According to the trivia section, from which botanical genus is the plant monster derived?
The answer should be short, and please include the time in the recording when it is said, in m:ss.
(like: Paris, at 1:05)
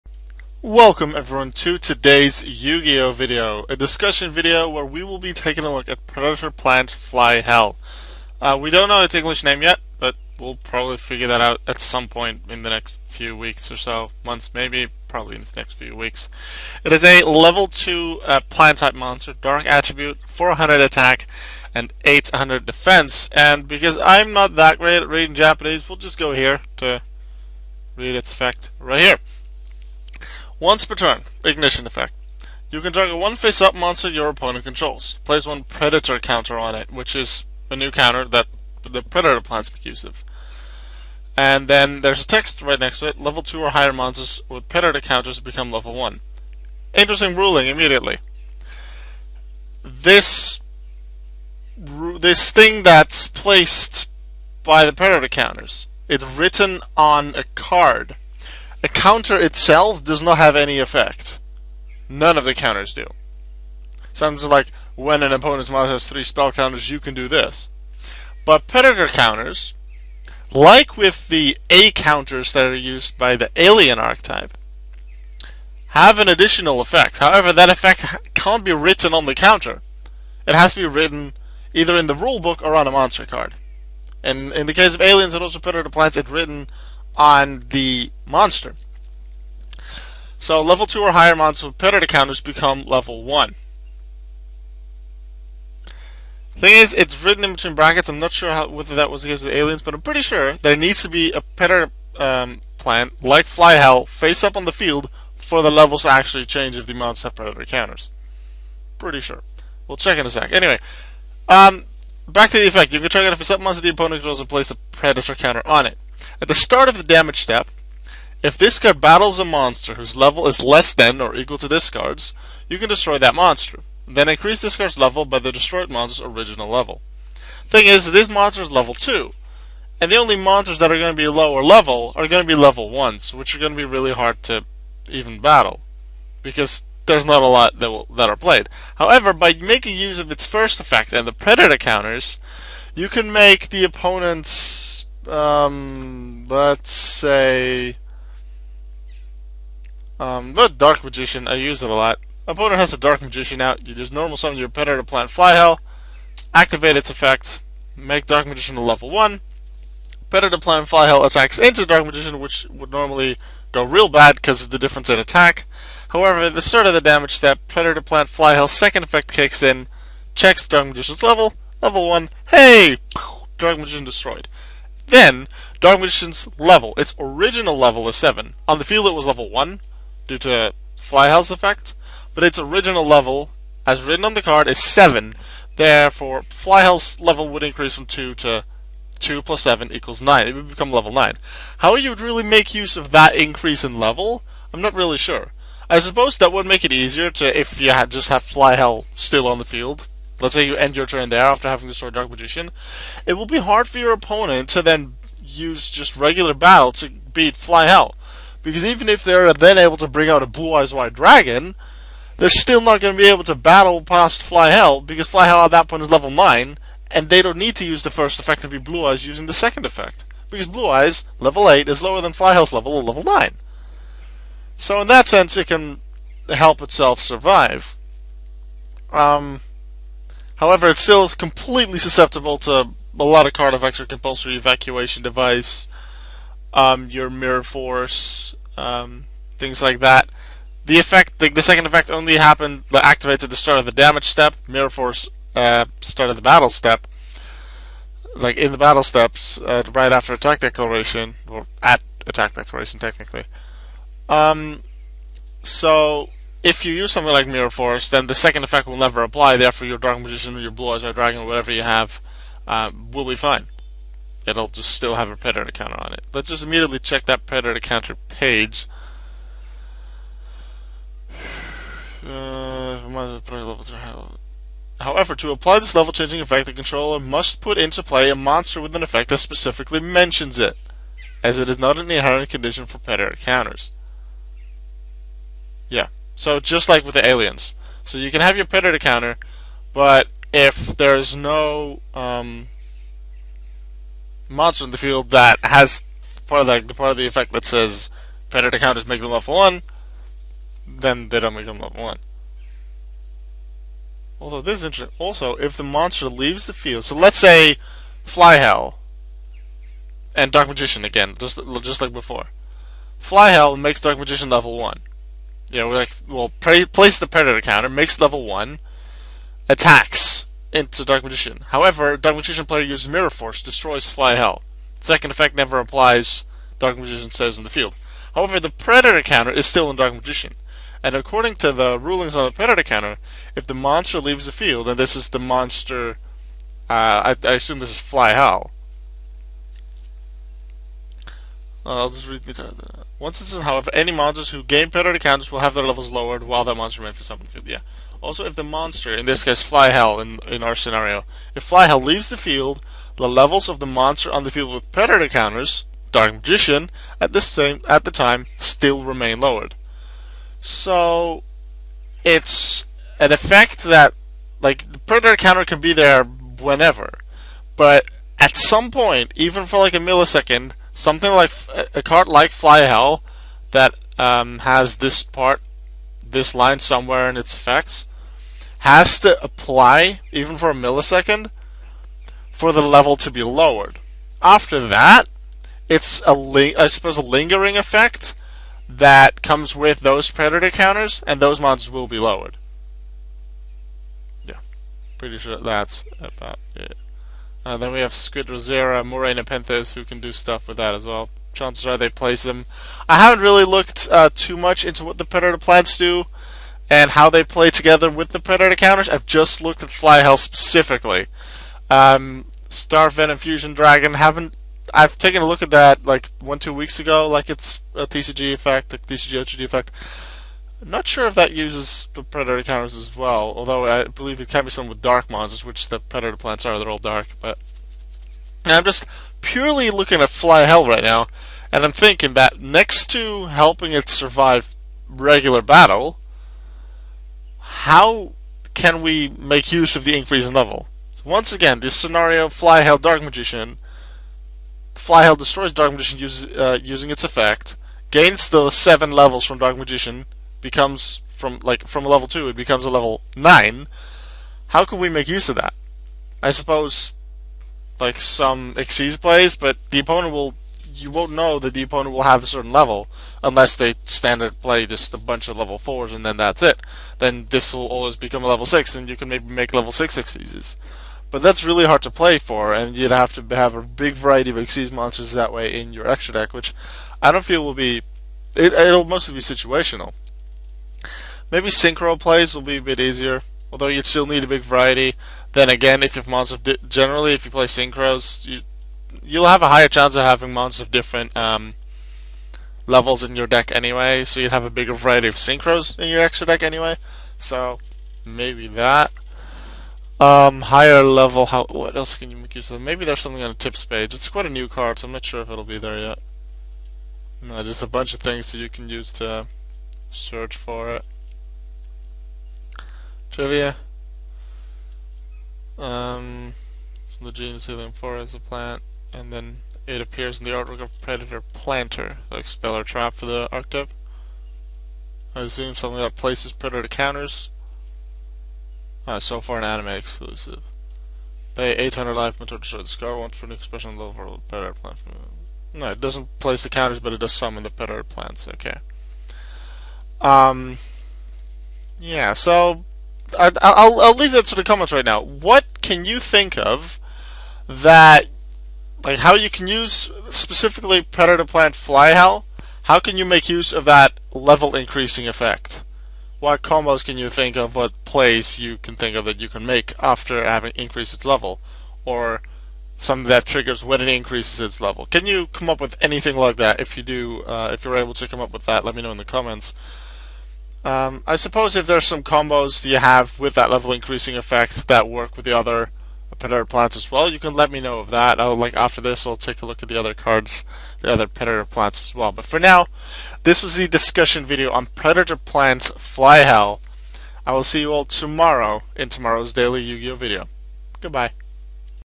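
Heliamphora, at 8:37.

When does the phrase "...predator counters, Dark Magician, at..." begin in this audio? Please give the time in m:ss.
5:54.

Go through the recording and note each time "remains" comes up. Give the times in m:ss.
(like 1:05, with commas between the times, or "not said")
5:47, 5:59.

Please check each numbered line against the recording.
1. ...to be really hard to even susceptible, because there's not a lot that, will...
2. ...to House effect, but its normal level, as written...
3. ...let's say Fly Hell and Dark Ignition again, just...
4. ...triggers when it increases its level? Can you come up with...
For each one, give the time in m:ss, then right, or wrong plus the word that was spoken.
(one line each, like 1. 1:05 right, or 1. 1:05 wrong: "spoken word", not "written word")
1. 2:13 wrong: "battle", not "susceptible"
2. 3:00 wrong: "original", not "normal"
3. 5:07 wrong: "Magician", not "Ignition"
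4. 9:23 right.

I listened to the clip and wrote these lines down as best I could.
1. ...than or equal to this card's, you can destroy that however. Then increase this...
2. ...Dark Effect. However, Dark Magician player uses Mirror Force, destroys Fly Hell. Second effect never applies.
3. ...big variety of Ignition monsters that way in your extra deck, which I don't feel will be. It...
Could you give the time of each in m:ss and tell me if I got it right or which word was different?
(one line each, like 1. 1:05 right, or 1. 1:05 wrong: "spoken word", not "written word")
1. 2:00 wrong: "monster", not "however"
2. 5:21 wrong: "Magician", not "Effect"
3. 7:53 wrong: "Xyz", not "Ignition".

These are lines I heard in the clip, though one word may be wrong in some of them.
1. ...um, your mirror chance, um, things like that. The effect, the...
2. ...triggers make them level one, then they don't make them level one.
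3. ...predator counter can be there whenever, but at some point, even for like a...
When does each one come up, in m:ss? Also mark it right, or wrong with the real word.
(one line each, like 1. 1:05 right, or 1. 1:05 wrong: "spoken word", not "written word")
1. 3:56 wrong: "force", not "chance"
2. 4:58 wrong: "counters", not "triggers"
3. 6:04 right.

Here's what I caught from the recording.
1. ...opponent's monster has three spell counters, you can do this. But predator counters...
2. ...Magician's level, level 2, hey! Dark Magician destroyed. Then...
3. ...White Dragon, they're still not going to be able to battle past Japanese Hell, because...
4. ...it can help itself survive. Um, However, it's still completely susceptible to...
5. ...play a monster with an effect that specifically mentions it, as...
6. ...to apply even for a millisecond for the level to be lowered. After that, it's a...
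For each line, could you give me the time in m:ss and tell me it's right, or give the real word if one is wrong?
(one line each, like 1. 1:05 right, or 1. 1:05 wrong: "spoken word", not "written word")
1. 1:05 right
2. 2:50 wrong: "1", not "2"
3. 3:30 wrong: "Fly", not "Japanese"
4. 3:45 right
5. 4:38 right
6. 6:19 right.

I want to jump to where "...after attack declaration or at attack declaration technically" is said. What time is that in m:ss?
4:10.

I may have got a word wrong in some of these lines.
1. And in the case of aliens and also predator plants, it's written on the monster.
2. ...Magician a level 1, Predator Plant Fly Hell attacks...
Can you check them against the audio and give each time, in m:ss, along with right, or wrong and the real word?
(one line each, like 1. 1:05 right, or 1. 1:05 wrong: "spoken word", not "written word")
1. 1:24 right
2. 2:38 right.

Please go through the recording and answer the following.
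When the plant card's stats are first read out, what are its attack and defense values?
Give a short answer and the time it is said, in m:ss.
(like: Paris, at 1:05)
400 attack, 800 defense, at 0:20.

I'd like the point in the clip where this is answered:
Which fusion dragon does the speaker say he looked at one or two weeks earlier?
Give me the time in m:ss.
6:52.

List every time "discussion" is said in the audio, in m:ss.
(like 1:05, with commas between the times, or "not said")
0:03, 9:43.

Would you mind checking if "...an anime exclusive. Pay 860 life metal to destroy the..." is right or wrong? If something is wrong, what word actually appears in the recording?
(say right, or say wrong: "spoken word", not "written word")
wrong: "800", not "860".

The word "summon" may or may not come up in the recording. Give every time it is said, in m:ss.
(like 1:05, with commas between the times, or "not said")
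2:34, 8:57.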